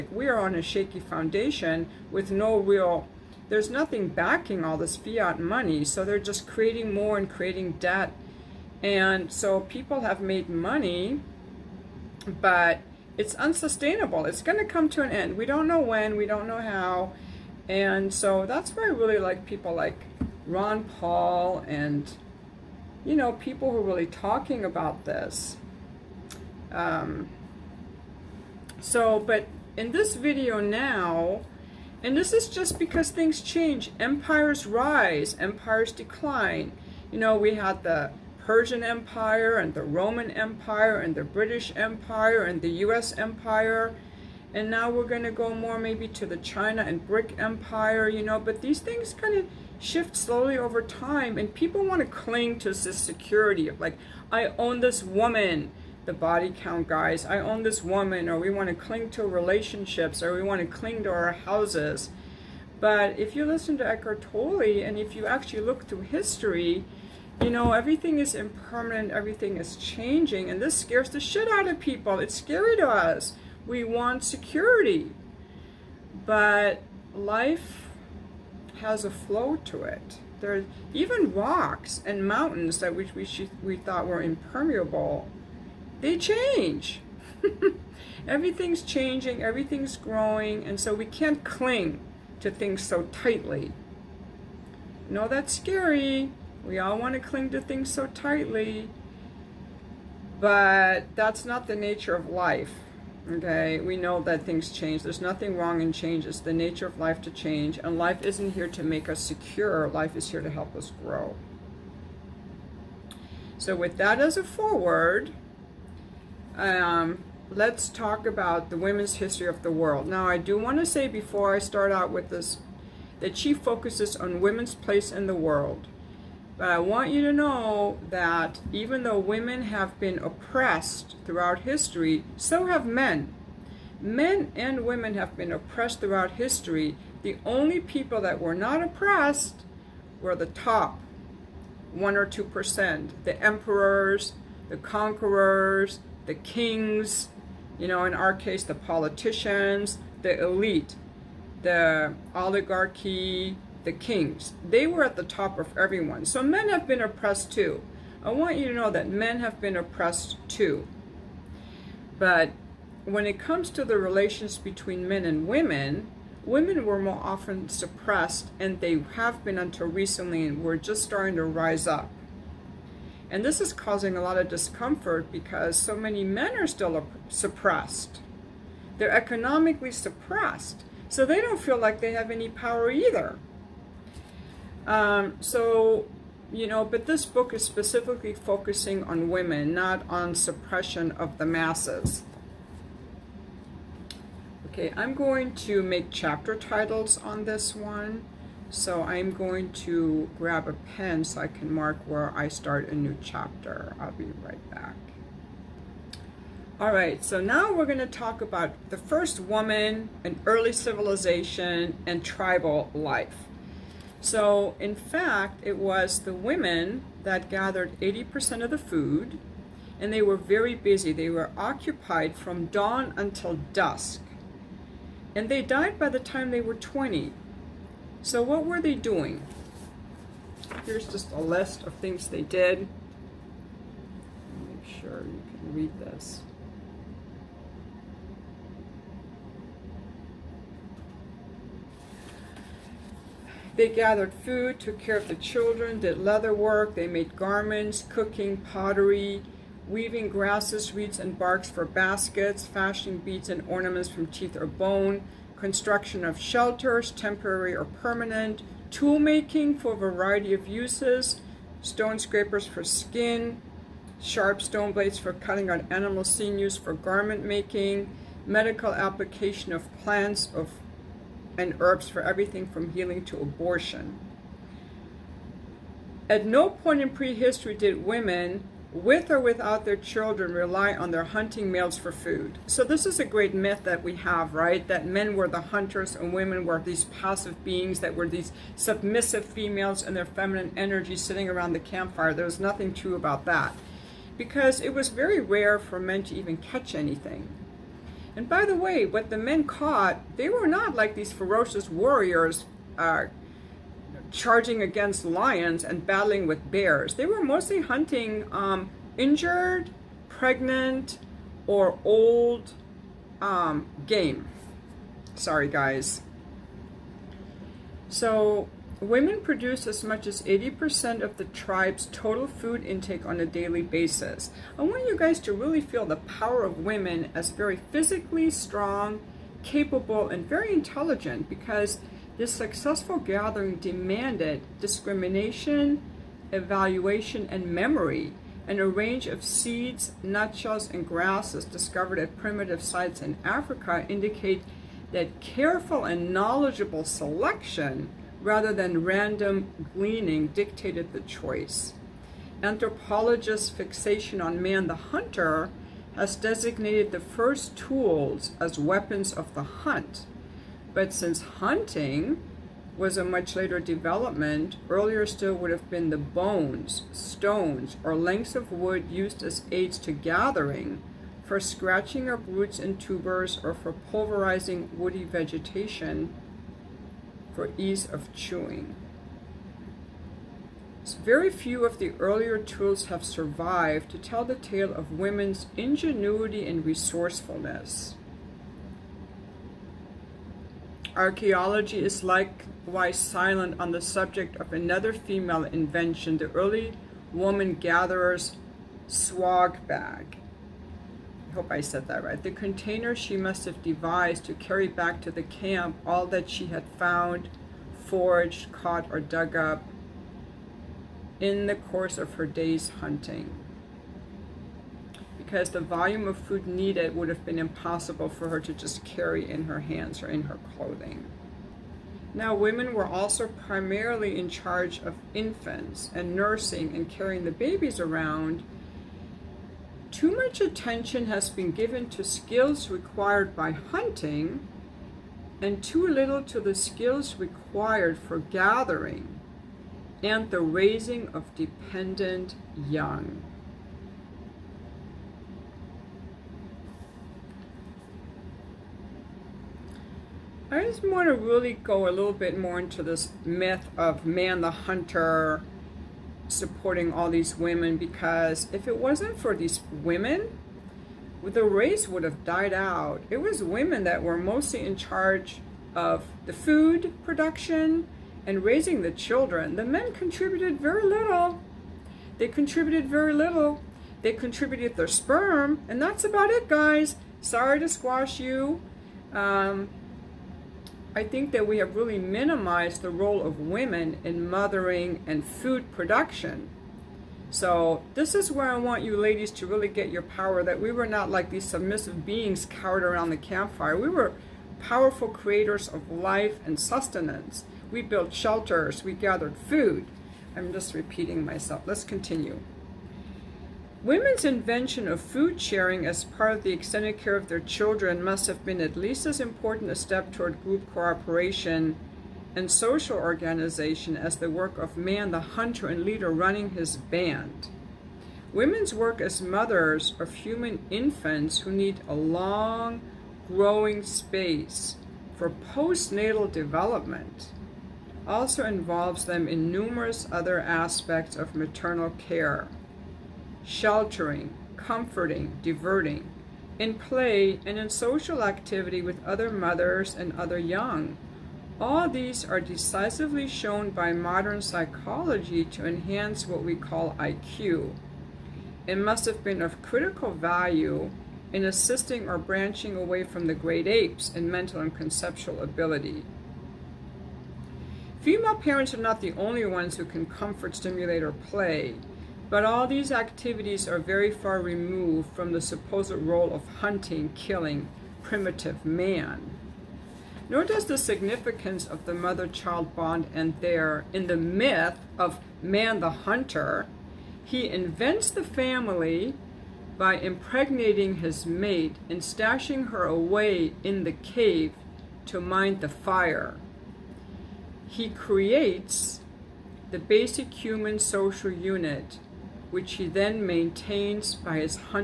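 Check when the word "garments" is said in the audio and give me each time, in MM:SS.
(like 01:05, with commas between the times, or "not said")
04:07, 04:26.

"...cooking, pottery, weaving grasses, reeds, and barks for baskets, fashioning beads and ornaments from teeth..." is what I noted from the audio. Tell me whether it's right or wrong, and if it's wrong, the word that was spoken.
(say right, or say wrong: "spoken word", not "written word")
right.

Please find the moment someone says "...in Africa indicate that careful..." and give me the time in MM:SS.
05:43.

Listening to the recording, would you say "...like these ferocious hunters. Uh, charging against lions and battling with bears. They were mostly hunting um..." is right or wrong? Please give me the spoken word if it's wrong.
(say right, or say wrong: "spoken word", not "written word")
wrong: "warriors", not "hunters".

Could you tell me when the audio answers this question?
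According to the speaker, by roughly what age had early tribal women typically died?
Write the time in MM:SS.
03:46.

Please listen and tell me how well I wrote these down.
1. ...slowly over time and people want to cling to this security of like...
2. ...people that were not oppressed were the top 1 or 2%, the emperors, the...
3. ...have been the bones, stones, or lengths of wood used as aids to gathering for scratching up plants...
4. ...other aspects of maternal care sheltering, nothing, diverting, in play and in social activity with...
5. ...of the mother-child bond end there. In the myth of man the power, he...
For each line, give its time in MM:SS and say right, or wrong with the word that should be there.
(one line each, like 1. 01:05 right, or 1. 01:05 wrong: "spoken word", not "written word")
1. 00:50 right
2. 02:17 right
3. 06:05 wrong: "roots", not "plants"
4. 08:50 wrong: "comforting", not "nothing"
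5. 09:31 wrong: "hunter", not "power".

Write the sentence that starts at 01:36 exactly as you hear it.
We all want to cling to things so tightly, but that's not the nature of life.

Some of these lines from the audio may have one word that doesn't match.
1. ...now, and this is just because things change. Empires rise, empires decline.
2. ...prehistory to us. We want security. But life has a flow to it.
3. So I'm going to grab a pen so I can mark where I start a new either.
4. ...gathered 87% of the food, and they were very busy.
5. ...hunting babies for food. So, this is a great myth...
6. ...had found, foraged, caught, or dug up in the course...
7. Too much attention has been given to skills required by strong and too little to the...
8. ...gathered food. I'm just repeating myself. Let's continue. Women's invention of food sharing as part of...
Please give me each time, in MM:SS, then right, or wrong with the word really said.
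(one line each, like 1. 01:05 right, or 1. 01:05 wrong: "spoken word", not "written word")
1. 00:30 right
2. 01:12 wrong: "scary", not "prehistory"
3. 03:18 wrong: "chapter", not "either"
4. 03:37 wrong: "80", not "87"
5. 04:41 wrong: "males", not "babies"
6. 06:46 right
7. 07:10 wrong: "hunting", not "strong"
8. 08:19 right.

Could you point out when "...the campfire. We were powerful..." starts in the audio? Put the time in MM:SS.
08:13.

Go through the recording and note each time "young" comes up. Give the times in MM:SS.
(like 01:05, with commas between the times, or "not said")
07:22, 09:00.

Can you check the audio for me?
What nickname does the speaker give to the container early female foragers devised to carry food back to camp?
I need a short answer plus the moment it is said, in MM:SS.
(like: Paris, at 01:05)
swag bag, at 06:39.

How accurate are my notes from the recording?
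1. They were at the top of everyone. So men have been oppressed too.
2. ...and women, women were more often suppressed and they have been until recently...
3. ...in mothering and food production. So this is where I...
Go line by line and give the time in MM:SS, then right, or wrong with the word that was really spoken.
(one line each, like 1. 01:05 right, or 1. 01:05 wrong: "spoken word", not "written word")
1. 02:34 right
2. 02:45 right
3. 08:04 right.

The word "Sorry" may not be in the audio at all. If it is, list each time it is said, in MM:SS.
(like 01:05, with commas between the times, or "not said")
05:15, 07:57.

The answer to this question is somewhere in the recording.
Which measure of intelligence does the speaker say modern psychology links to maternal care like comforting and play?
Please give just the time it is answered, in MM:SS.
09:07.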